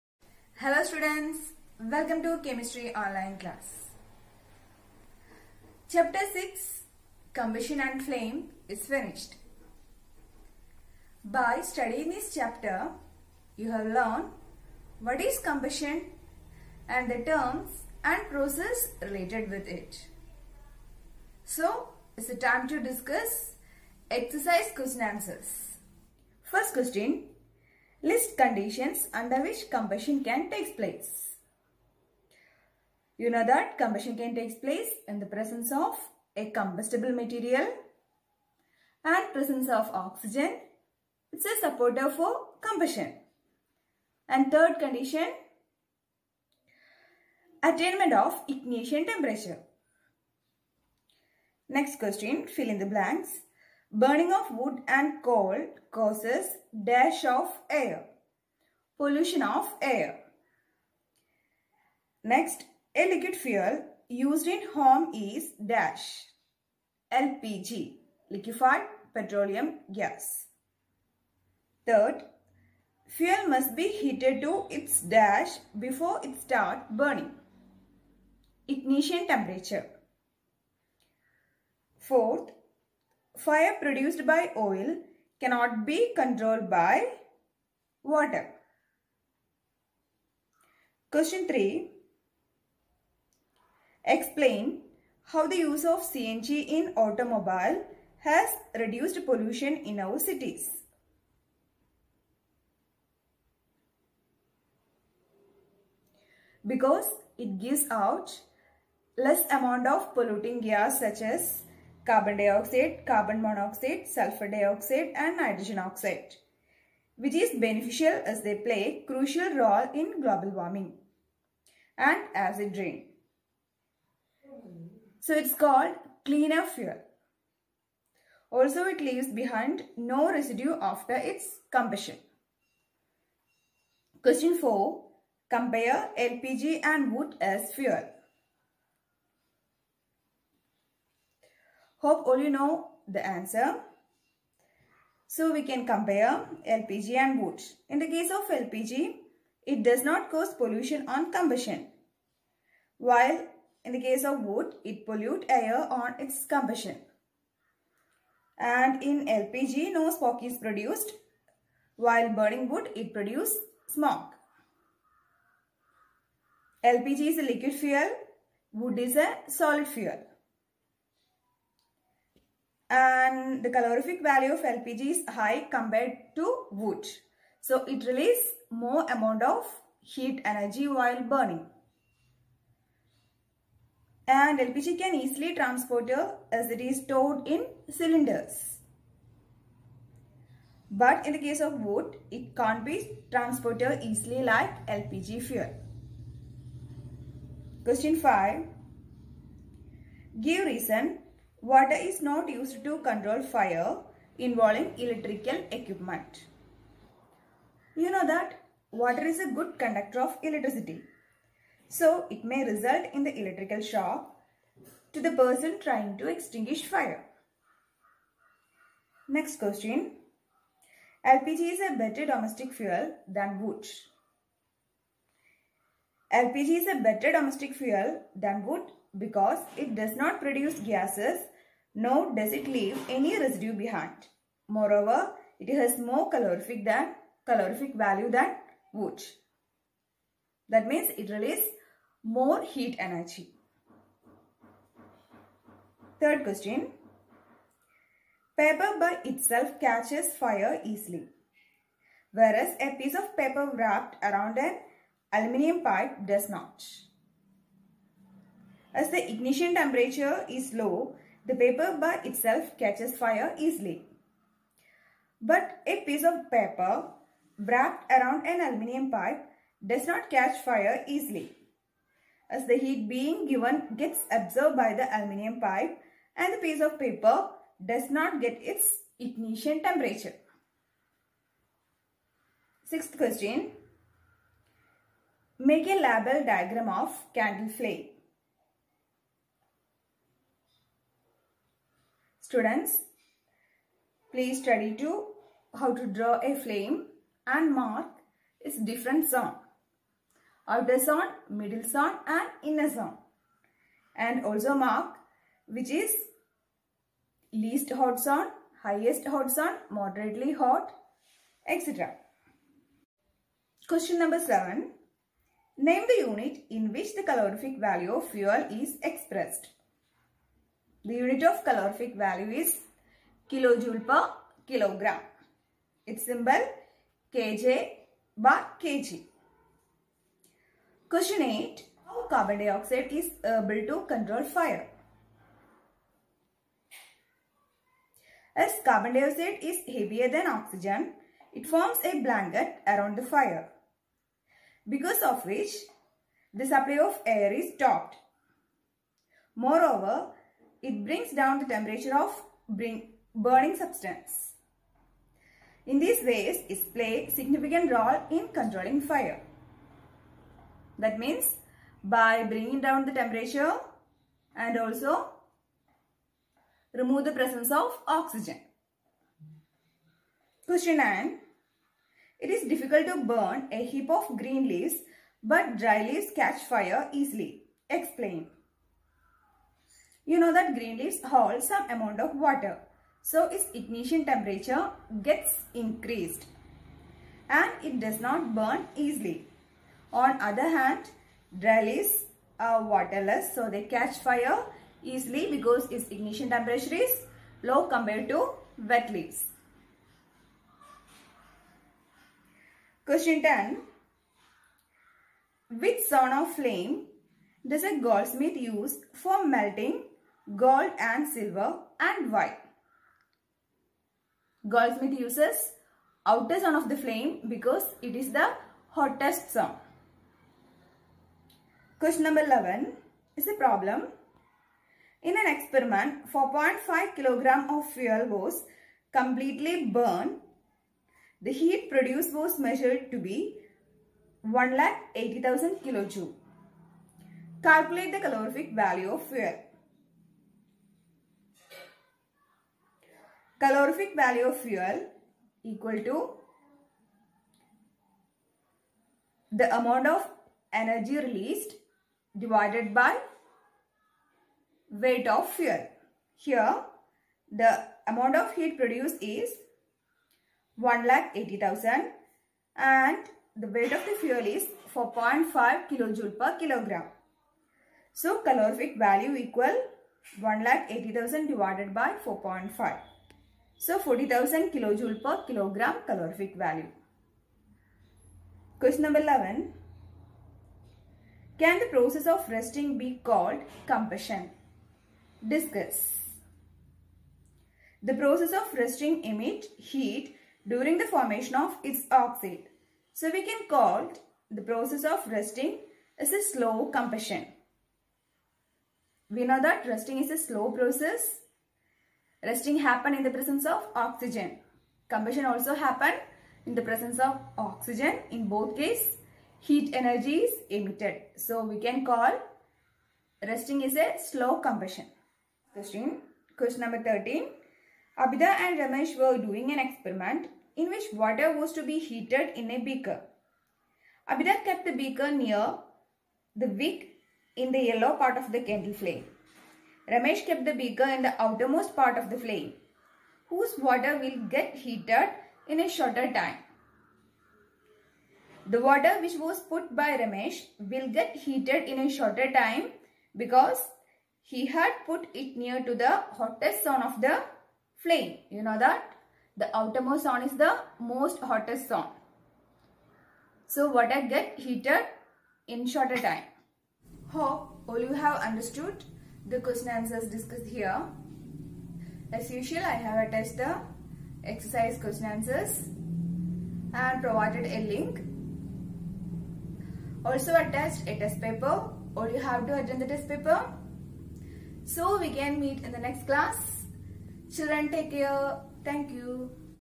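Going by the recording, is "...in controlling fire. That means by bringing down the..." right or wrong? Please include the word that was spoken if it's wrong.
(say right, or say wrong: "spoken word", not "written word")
right.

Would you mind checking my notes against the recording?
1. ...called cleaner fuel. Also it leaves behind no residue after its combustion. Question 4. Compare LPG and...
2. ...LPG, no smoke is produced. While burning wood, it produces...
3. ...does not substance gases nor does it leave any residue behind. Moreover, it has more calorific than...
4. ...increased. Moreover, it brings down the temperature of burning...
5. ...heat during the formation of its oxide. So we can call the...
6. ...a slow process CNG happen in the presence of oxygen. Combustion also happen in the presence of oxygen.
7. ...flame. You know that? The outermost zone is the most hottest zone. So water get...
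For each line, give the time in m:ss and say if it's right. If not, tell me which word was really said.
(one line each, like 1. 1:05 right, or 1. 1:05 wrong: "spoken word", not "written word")
1. 2:05 right
2. 2:39 right
3. 3:49 wrong: "produce", not "substance"
4. 5:47 wrong: "stopped", not "increased"
5. 8:09 right
6. 8:20 wrong: "Rusting", not "CNG"
7. 9:07 right.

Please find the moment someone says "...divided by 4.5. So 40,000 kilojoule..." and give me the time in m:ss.
7:51.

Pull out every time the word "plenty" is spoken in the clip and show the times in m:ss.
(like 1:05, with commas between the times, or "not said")
not said.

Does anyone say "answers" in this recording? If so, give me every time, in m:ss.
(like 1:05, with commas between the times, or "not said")
0:25, 2:23, 9:19, 9:25.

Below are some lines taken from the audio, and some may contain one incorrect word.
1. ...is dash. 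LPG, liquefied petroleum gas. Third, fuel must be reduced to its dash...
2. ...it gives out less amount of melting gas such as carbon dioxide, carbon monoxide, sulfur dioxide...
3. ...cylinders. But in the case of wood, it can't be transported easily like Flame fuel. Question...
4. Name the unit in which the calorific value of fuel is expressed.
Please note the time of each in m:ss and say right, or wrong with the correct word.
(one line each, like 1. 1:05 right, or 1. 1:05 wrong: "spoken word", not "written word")
1. 1:05 wrong: "heated", not "reduced"
2. 1:47 wrong: "polluting", not "melting"
3. 3:07 wrong: "LPG", not "Flame"
4. 5:15 right.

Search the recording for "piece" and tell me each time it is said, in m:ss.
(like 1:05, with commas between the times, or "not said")
4:13, 4:26, 4:36.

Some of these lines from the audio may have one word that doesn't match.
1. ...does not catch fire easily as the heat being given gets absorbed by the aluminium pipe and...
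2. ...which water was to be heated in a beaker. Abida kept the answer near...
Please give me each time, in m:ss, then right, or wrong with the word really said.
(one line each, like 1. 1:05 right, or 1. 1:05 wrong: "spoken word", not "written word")
1. 4:29 right
2. 8:40 wrong: "beaker", not "answer".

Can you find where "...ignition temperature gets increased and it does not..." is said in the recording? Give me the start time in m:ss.
6:23.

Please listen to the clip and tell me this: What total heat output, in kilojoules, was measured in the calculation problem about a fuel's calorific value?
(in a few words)
180000 kilojoule.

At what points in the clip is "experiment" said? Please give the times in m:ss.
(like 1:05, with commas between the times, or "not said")
7:05, 8:39.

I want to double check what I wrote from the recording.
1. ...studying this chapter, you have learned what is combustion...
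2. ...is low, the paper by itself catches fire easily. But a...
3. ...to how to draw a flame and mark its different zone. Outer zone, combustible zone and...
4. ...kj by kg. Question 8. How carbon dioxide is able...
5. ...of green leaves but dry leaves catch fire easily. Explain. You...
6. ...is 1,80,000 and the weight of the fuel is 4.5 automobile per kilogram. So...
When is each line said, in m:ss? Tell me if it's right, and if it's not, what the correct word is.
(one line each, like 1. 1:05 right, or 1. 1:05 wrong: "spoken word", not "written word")
1. 0:11 right
2. 4:20 right
3. 4:55 wrong: "middle", not "combustible"
4. 5:27 right
5. 6:14 right
6. 7:39 wrong: "kilojoule", not "automobile".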